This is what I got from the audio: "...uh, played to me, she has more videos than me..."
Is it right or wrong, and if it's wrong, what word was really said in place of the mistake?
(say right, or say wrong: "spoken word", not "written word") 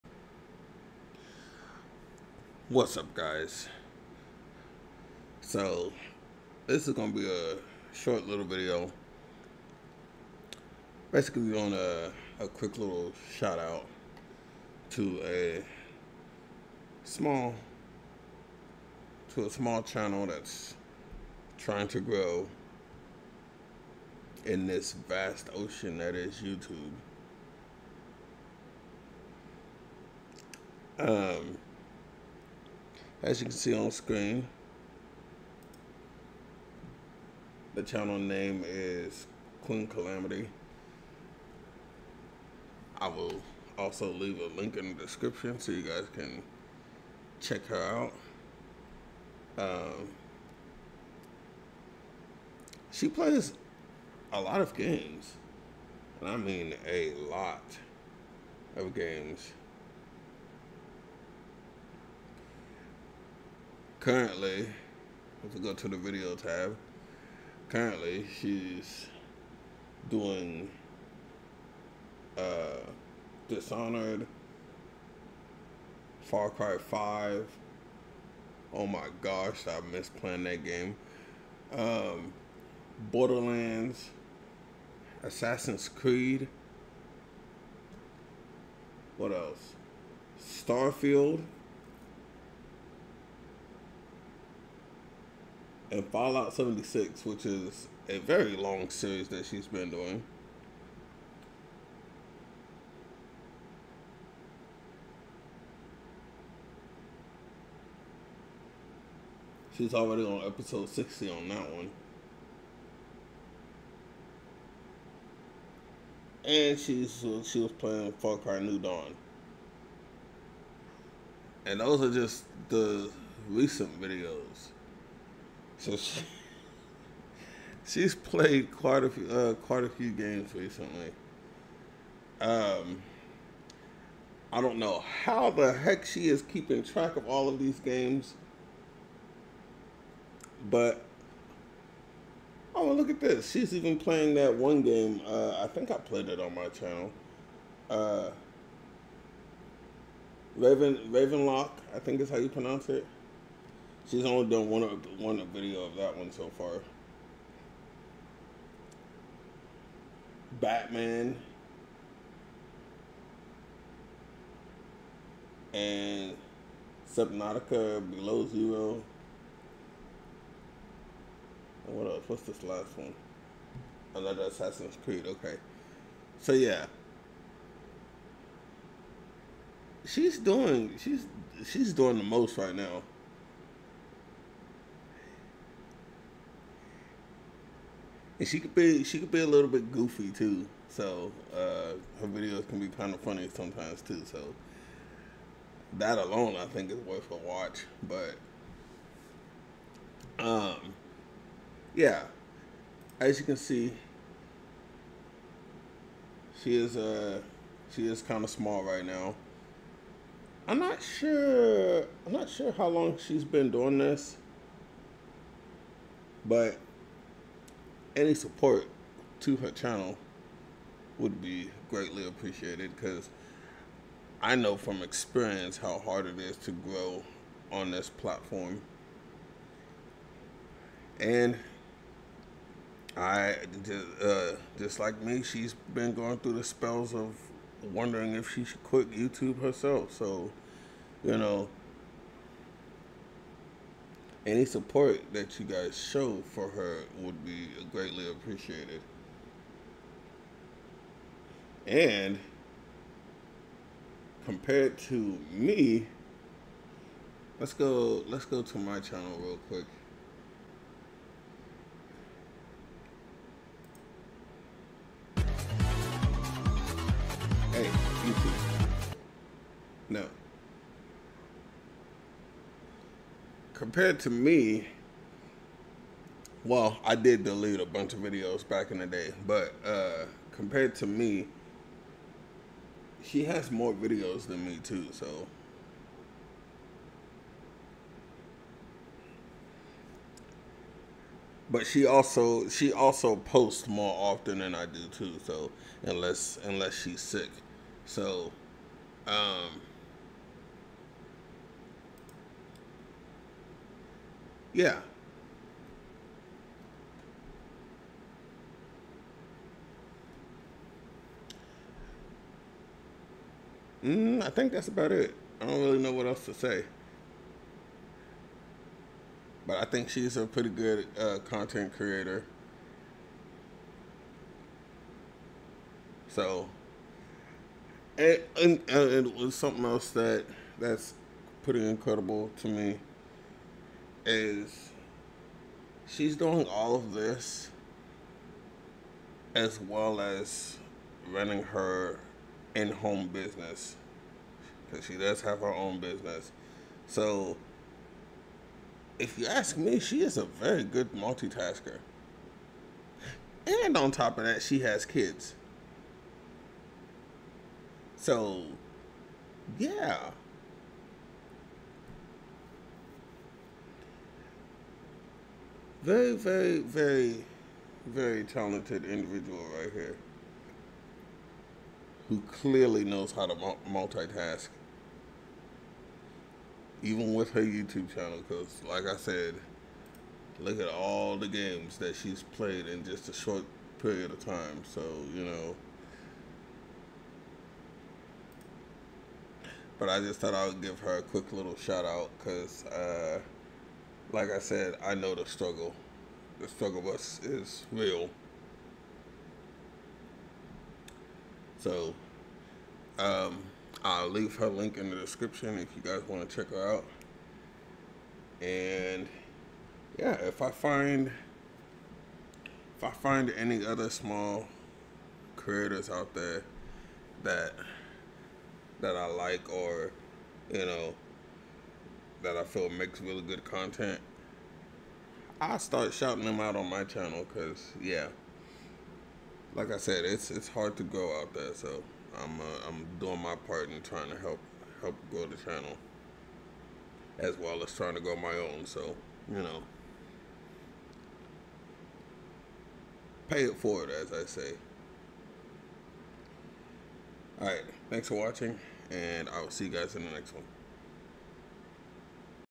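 wrong: "compared", not "played".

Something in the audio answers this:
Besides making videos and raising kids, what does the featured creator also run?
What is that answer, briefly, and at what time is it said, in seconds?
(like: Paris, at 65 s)
In-home business, at 342 s.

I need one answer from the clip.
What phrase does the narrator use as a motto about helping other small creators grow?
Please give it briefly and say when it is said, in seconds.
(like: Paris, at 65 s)
Pay it forward, at 443 s.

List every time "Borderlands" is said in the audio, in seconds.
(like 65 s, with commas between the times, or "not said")
83 s.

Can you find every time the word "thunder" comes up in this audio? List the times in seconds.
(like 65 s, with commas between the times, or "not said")
not said.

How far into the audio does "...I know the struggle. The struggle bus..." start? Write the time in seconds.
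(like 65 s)
395 s.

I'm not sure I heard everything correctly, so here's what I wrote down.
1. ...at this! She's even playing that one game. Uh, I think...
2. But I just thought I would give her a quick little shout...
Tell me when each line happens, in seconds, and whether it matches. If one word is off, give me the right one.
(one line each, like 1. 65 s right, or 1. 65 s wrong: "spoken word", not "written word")
1. 143 s right
2. 389 s right.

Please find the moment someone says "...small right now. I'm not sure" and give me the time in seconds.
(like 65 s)
208 s.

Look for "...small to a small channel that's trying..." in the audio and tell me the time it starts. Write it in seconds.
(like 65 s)
17 s.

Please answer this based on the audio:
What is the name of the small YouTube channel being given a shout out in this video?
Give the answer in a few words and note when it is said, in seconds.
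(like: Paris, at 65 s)
Queen Calamity, at 39 s.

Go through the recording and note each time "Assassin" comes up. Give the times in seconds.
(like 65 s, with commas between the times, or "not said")
85 s, 174 s.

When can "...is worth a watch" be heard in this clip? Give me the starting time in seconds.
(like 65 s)
196 s.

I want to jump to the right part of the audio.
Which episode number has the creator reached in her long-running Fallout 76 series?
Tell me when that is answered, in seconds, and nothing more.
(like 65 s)
110 s.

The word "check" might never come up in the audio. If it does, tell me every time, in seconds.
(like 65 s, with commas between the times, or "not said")
47 s, 406 s.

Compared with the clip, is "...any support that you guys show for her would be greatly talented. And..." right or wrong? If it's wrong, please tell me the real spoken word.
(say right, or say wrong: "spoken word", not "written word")
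wrong: "appreciated", not "talented".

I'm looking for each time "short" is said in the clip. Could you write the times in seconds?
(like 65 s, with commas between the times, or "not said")
7 s, 383 s.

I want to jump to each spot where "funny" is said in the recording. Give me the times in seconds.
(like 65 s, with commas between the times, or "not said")
193 s.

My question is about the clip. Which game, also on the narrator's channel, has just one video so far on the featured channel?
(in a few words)
Ravenlok.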